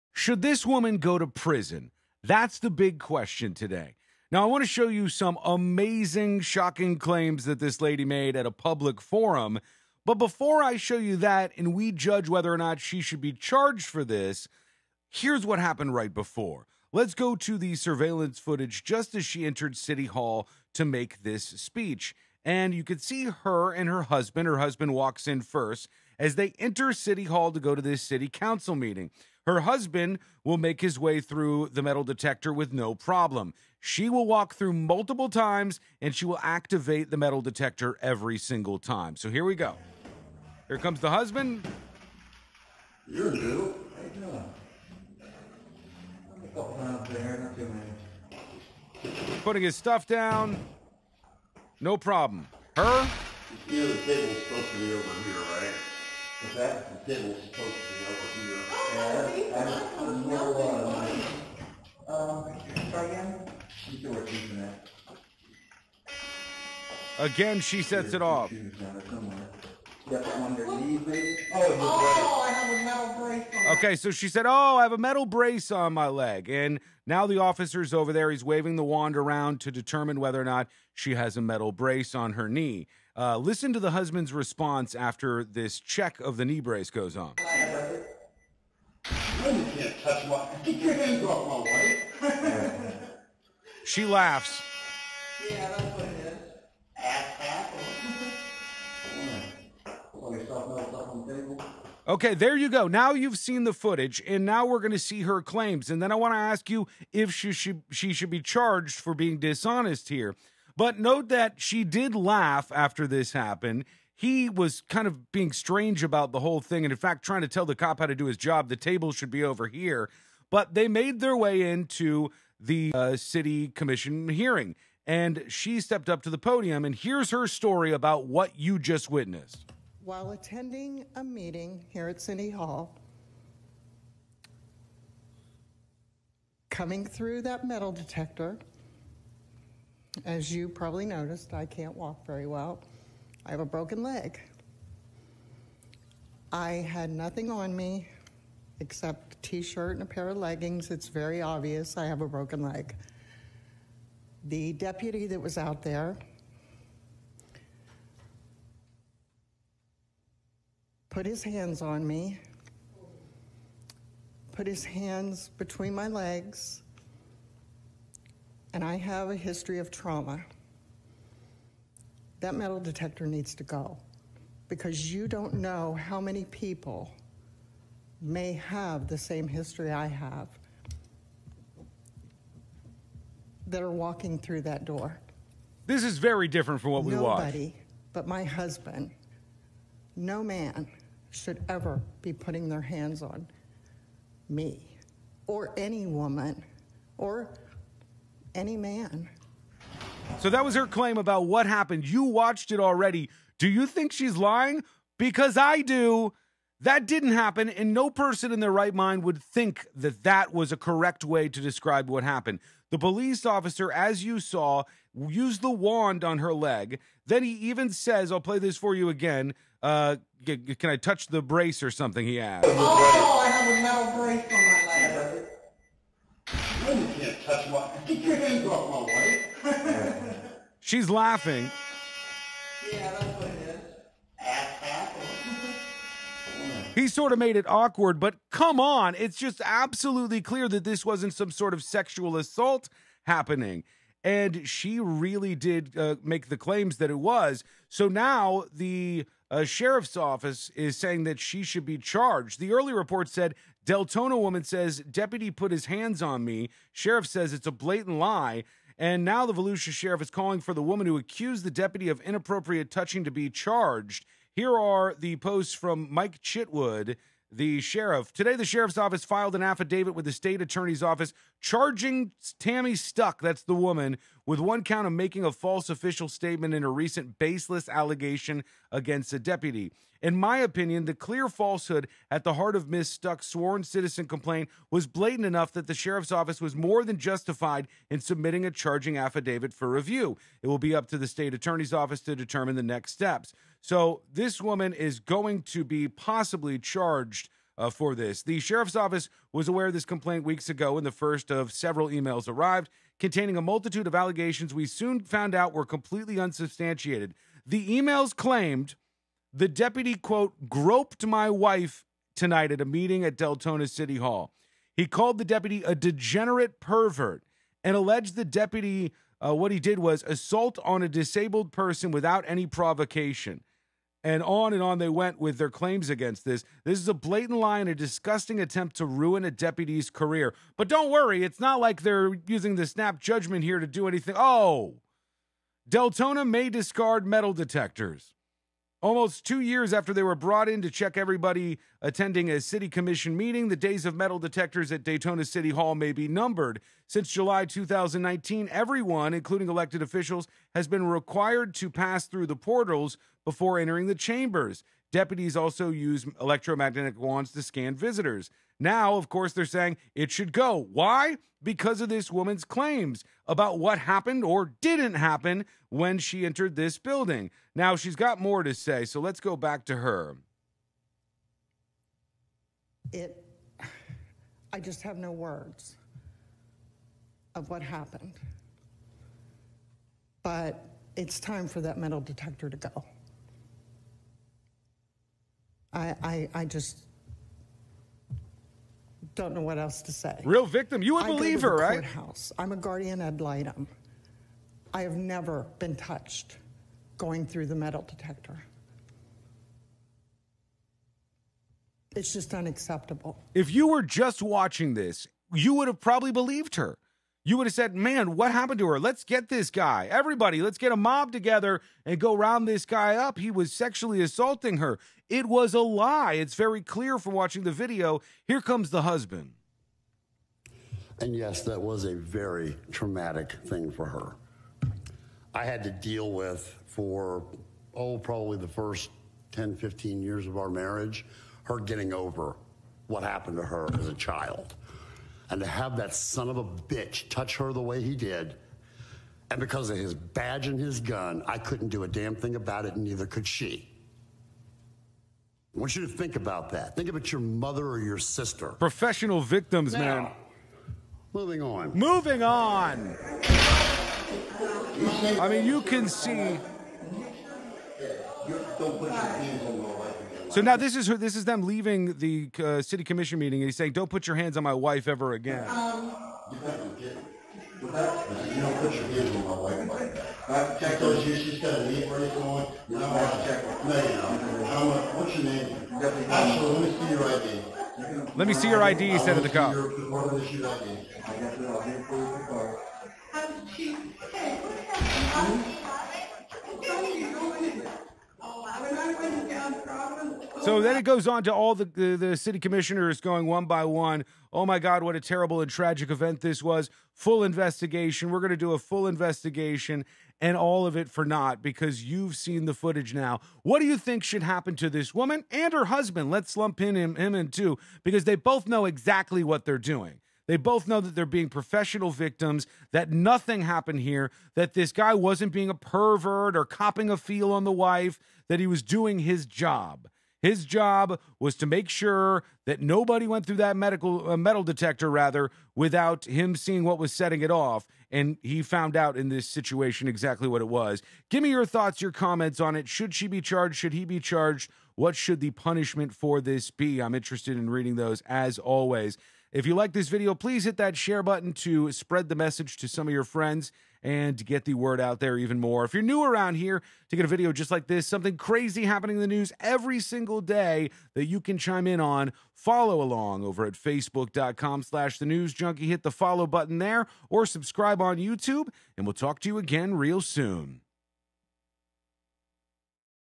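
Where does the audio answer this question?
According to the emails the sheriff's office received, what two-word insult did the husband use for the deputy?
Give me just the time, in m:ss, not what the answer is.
5:15.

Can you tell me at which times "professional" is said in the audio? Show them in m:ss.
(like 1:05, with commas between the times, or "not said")
7:28, 8:31.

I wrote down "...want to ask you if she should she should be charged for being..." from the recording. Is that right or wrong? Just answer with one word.
right.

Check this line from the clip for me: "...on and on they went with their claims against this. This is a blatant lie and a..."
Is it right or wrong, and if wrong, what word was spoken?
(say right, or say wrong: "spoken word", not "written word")
right.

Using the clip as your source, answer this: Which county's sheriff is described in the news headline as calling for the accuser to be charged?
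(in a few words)
Volusia.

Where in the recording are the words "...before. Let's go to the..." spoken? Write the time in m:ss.
0:16.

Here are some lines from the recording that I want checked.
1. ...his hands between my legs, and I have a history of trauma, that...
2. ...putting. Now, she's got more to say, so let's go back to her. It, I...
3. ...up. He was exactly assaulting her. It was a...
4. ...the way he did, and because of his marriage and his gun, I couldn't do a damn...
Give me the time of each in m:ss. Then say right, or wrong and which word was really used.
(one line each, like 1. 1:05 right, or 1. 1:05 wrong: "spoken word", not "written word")
1. 2:44 right
2. 6:06 wrong: "building", not "putting"
3. 6:53 wrong: "sexually", not "exactly"
4. 7:17 wrong: "badge", not "marriage".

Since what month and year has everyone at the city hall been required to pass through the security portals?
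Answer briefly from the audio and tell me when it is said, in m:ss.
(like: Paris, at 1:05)
July 2019, at 5:47.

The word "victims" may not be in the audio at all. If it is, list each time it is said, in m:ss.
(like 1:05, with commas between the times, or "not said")
6:30, 7:29, 8:32.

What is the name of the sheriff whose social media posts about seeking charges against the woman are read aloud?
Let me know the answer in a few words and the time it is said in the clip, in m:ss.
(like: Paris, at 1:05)
Mike Chitwood, at 4:26.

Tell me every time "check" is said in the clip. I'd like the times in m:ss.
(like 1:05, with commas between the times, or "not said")
1:25, 5:40.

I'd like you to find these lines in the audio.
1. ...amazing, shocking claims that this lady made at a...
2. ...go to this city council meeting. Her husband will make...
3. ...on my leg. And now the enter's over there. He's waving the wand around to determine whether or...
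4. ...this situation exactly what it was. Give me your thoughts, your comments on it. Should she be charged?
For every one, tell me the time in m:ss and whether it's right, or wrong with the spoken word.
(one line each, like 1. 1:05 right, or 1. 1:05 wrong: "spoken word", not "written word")
1. 0:05 right
2. 0:27 right
3. 1:15 wrong: "officer", not "enter"
4. 8:49 right.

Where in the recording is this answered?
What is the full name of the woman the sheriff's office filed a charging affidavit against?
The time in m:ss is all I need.
4:32.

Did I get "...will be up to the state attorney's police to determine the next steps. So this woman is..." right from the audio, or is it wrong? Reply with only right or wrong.
wrong.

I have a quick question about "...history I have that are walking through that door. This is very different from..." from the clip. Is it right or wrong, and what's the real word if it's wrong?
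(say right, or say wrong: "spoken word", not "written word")
right.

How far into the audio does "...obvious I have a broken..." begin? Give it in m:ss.
2:31.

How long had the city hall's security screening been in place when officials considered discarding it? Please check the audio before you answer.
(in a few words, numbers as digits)
Almost two years.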